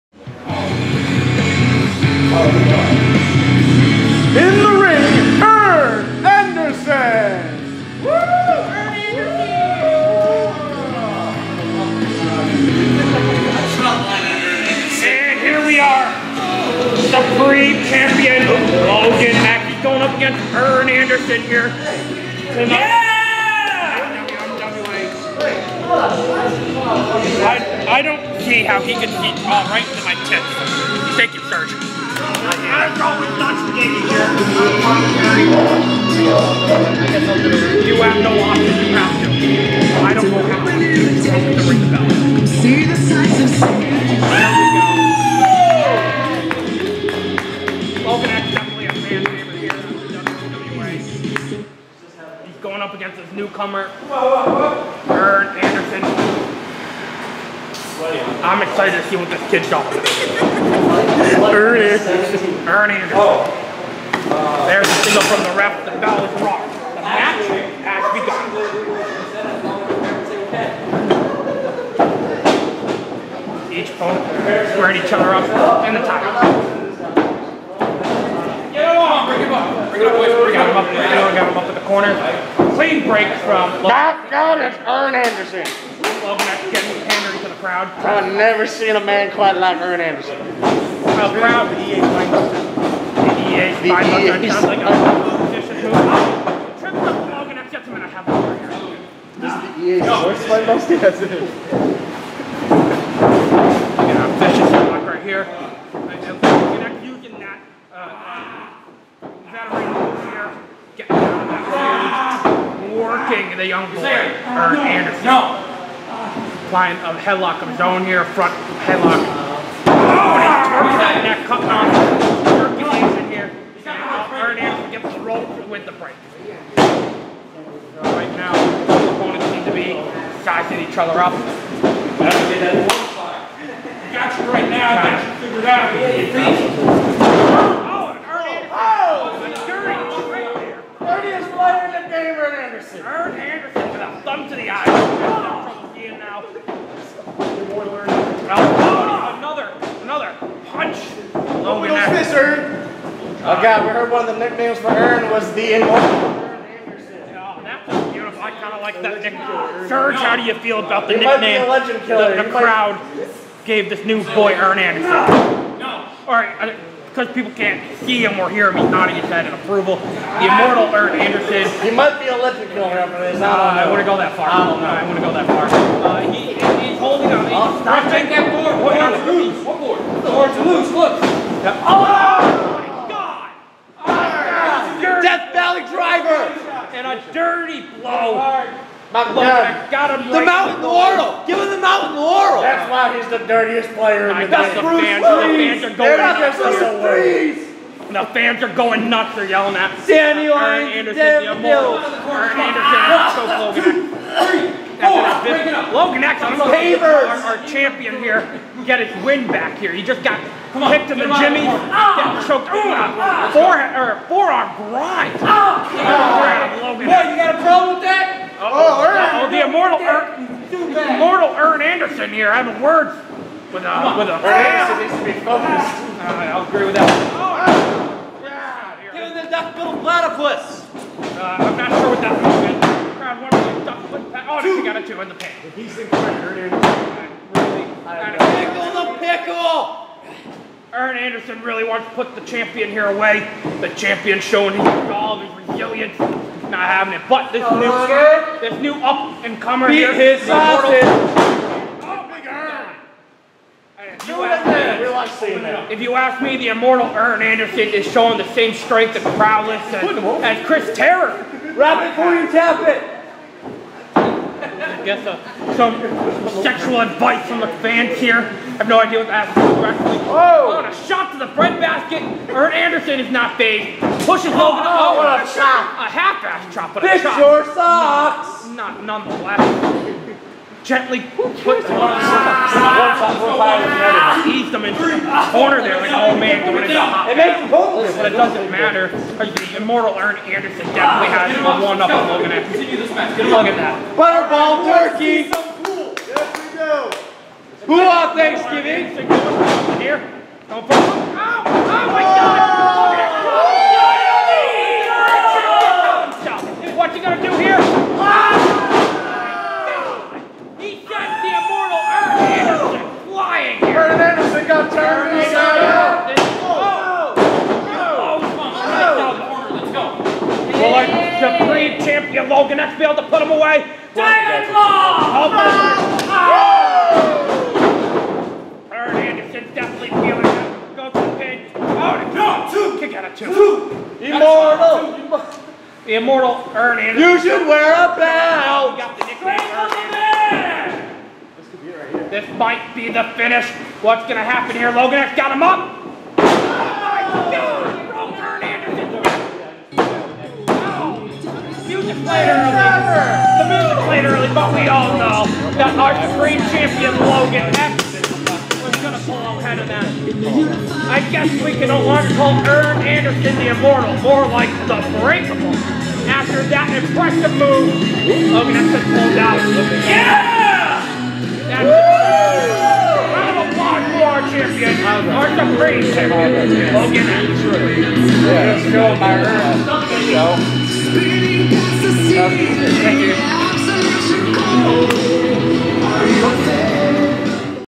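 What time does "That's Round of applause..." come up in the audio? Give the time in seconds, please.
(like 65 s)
371 s.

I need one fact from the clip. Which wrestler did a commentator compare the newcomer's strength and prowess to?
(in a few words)
Chris Terror.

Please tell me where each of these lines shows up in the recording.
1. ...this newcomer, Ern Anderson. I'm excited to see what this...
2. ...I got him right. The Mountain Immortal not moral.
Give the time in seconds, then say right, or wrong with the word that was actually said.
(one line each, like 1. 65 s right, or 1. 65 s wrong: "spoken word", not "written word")
1. 53 s right
2. 189 s right.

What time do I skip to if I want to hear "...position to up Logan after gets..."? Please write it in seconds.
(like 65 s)
95 s.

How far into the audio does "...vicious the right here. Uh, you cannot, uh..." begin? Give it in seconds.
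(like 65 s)
104 s.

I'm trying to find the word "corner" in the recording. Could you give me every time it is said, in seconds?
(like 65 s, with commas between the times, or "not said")
81 s, 285 s.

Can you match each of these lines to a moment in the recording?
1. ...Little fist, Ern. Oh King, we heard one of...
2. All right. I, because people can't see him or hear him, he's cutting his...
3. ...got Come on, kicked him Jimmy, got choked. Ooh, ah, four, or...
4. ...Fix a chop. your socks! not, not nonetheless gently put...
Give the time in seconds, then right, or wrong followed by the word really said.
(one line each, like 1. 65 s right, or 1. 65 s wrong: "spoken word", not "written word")
1. 151 s wrong: "God", not "King"
2. 166 s wrong: "nodding", not "cutting"
3. 210 s right
4. 277 s right.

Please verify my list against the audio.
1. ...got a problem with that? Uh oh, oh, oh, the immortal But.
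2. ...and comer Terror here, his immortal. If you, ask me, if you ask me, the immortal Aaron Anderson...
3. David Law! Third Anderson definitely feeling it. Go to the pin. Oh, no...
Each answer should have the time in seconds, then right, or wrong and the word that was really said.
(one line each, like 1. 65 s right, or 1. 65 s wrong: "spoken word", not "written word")
1. 217 s wrong: "Irk", not "But"
2. 249 s wrong: "Beat", not "Terror"
3. 324 s right.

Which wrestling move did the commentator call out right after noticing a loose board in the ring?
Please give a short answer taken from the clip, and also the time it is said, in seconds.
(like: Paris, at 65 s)
Death Valley driver, at 185 s.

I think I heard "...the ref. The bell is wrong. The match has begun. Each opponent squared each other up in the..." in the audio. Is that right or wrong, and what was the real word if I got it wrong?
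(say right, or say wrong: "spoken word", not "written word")
right.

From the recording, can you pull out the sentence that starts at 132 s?
That's what Got you right now, got you figured out.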